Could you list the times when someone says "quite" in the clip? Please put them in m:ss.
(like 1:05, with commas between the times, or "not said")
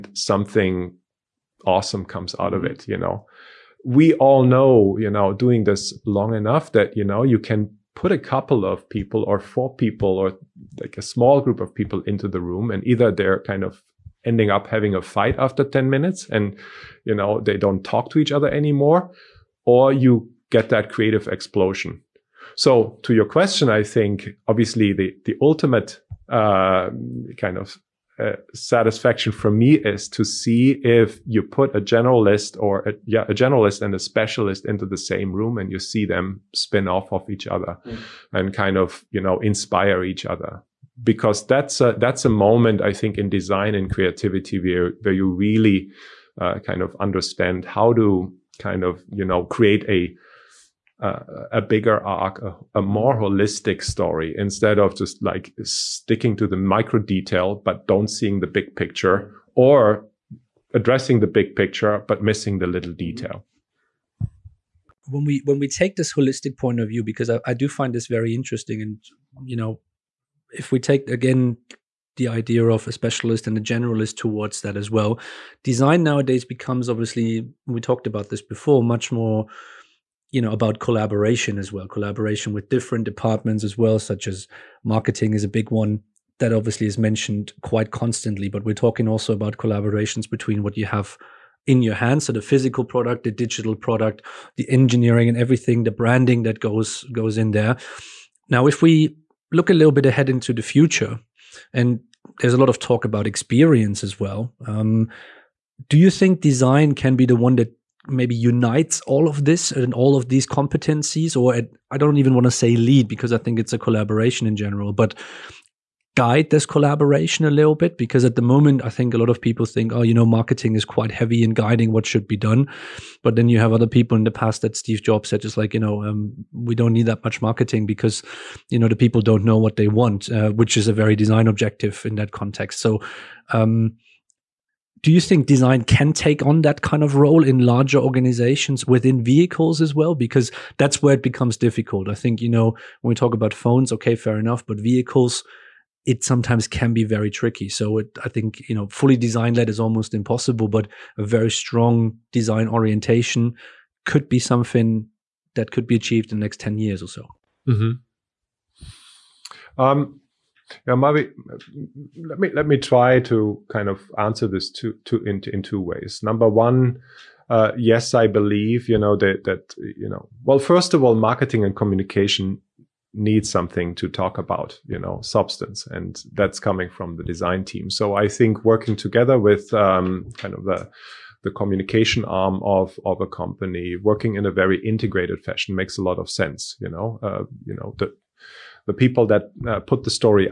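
1:27, 2:00.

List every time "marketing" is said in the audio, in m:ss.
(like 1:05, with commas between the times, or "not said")
1:24, 2:00, 2:07, 2:51.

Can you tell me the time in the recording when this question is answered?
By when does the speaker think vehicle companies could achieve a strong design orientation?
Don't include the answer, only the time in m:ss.
2:36.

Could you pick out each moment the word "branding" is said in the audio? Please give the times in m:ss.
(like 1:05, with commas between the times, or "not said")
1:35.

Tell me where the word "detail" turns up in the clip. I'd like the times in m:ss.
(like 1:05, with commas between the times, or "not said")
0:56, 1:02.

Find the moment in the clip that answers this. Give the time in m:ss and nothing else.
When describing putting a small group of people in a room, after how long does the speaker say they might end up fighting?
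0:15.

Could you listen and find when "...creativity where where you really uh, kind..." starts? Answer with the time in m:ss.
0:43.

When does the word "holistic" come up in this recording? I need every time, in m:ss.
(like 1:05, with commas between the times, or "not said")
0:53, 1:06.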